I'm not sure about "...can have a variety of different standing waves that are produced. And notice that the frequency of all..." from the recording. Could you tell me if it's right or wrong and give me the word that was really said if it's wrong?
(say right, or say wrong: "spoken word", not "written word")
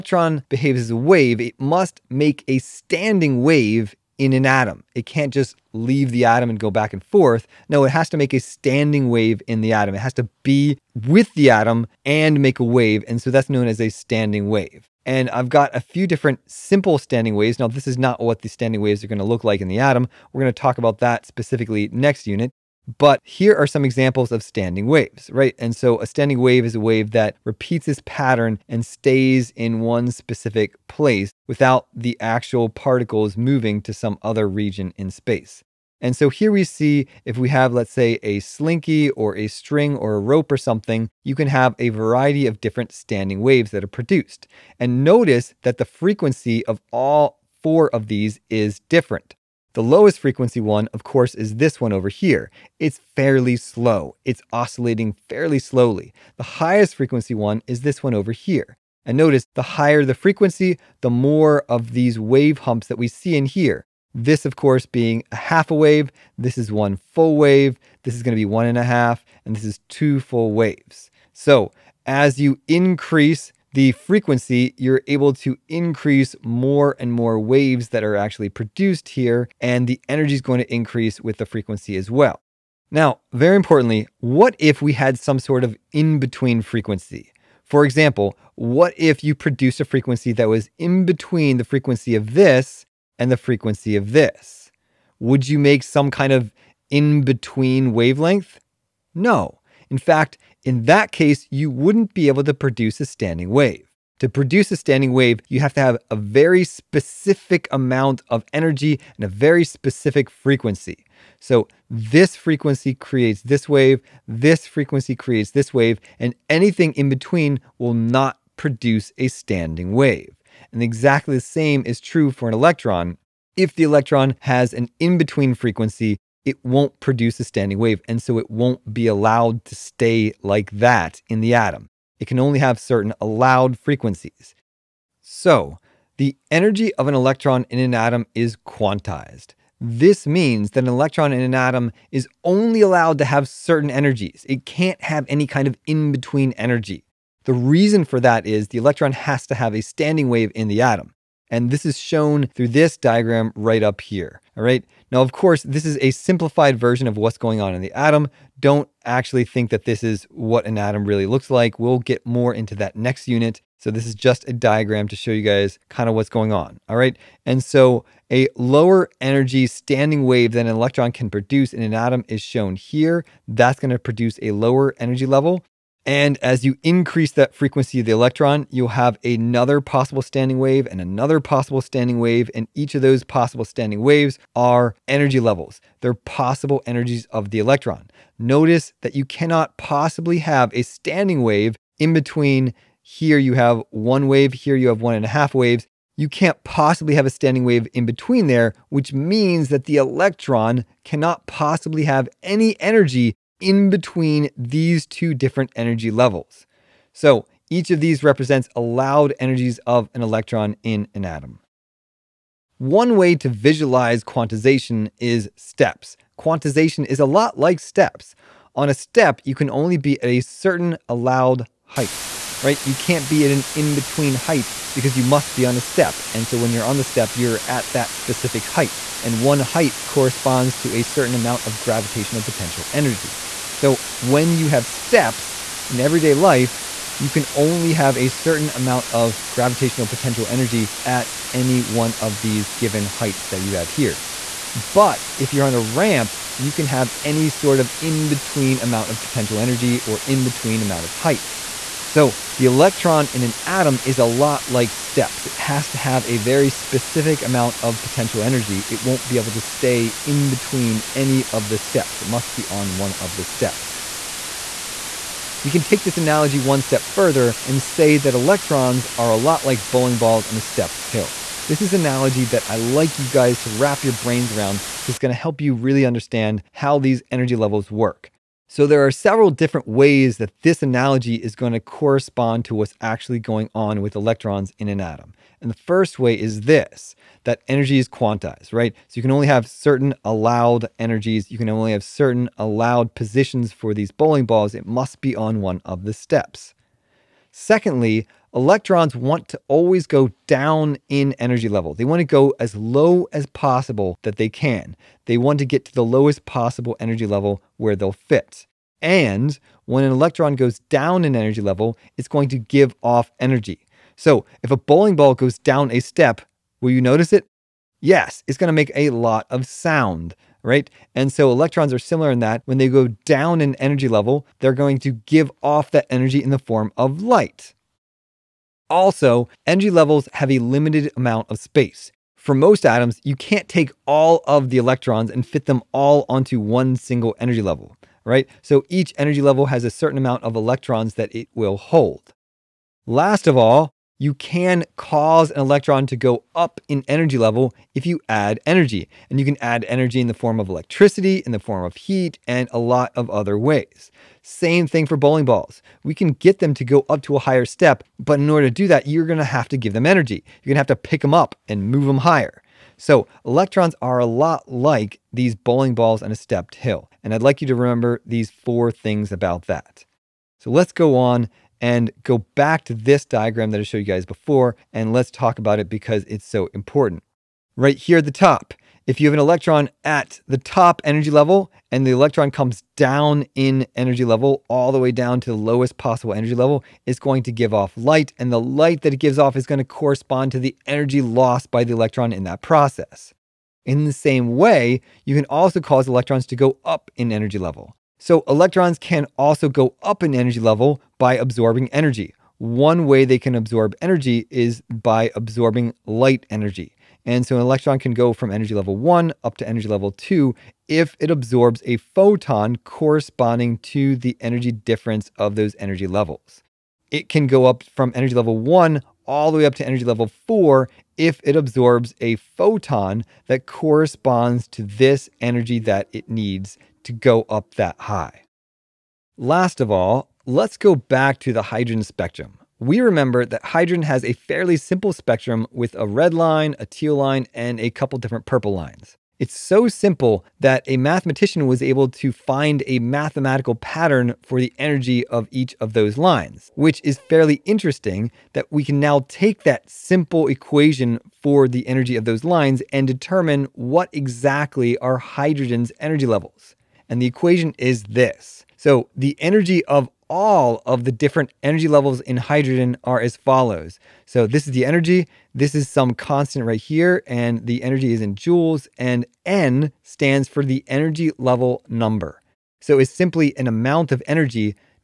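right.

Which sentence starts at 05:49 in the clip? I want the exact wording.
And you can add energy in the form of electricity, in the form of heat, and a lot of other ways.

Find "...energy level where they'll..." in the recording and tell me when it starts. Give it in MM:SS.
05:06.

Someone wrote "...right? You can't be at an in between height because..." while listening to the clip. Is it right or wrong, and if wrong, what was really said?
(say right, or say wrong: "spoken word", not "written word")
right.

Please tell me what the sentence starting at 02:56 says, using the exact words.
And as you increase that frequency of the electron, you'll have another possible standing wave and another possible standing wave.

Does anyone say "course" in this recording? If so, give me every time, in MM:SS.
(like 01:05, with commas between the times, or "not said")
00:51, 01:04, 02:35.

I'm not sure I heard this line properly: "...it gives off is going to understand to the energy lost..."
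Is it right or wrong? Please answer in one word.
wrong.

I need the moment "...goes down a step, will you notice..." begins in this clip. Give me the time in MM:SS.
05:15.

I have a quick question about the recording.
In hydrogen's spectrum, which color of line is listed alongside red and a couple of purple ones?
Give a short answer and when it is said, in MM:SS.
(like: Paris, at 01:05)
Teal, at 07:16.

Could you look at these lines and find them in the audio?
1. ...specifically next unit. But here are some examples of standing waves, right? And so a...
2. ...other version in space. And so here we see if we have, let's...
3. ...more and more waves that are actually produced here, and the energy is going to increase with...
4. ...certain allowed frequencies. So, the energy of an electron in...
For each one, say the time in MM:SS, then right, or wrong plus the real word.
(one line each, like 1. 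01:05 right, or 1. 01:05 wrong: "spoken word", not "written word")
1. 00:21 right
2. 00:34 wrong: "region", not "version"
3. 01:16 right
4. 02:12 right.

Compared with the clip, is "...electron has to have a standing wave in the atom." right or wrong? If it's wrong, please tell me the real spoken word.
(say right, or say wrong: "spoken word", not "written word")
right.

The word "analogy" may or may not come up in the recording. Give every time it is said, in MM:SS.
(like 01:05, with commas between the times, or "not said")
04:26, 04:31, 04:40.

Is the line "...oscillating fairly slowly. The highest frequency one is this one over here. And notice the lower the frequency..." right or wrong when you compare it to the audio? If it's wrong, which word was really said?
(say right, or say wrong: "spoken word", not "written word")
wrong: "higher", not "lower".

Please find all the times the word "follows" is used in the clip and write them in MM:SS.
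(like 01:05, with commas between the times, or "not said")
07:43.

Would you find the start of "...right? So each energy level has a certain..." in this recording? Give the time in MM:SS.
05:38.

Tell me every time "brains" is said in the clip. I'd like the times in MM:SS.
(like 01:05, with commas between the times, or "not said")
04:34.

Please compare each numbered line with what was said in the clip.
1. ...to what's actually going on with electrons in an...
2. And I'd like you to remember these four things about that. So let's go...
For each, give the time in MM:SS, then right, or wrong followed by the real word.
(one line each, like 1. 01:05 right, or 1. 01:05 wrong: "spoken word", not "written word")
1. 04:42 right
2. 06:07 right.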